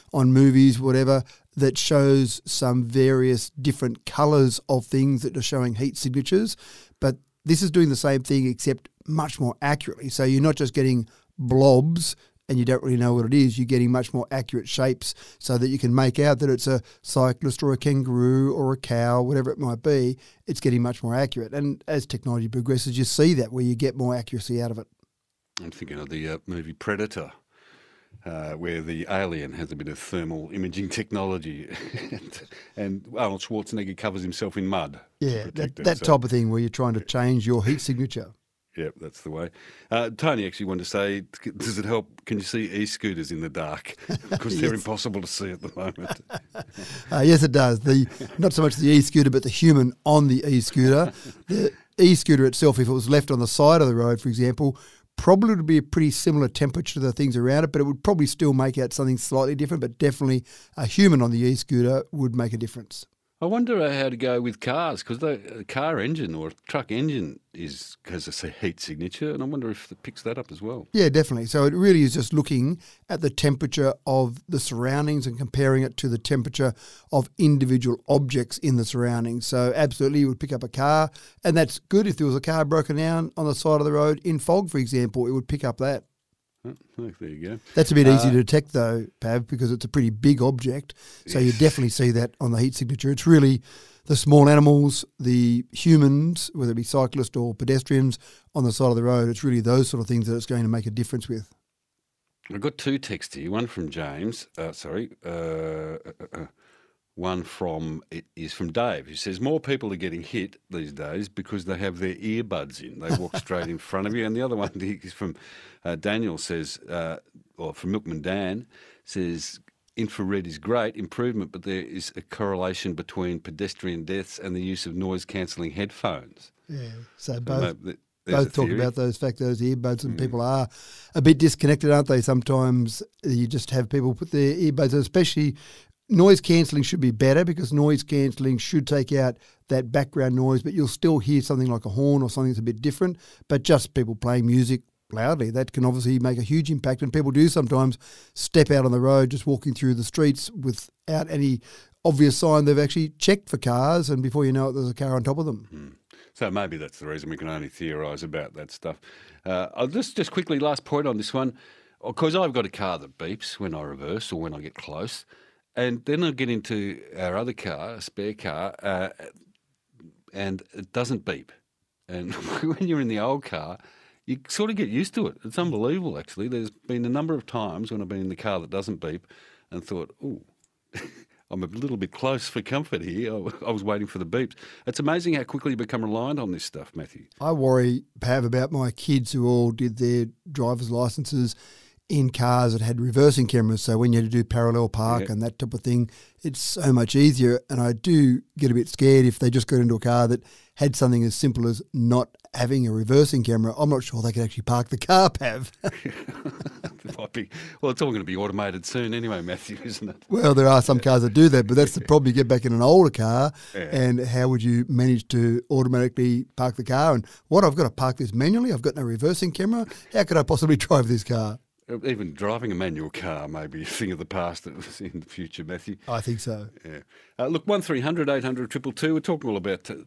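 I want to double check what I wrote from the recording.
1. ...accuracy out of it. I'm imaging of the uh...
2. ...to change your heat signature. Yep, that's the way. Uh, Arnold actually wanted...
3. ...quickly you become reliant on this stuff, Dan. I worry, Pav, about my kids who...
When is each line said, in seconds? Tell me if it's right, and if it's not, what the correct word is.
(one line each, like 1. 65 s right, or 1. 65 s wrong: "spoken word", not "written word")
1. 24 s wrong: "thinking", not "imaging"
2. 36 s wrong: "Tony", not "Arnold"
3. 185 s wrong: "Mathew", not "Dan".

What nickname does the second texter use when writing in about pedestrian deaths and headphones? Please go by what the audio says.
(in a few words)
Milkman Dan.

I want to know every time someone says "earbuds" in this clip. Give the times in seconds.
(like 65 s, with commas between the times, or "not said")
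112 s, 129 s, 134 s.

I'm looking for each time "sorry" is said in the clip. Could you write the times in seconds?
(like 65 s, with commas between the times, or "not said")
104 s.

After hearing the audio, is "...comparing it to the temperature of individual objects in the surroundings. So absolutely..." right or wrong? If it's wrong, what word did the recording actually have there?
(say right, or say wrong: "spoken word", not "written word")
right.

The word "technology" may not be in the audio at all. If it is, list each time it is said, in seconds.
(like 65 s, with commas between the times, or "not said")
22 s, 30 s.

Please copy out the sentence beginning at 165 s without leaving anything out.
And then I get into our other car, a spare car, uh, and it doesn't beep.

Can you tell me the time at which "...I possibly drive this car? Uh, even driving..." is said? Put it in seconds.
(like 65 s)
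220 s.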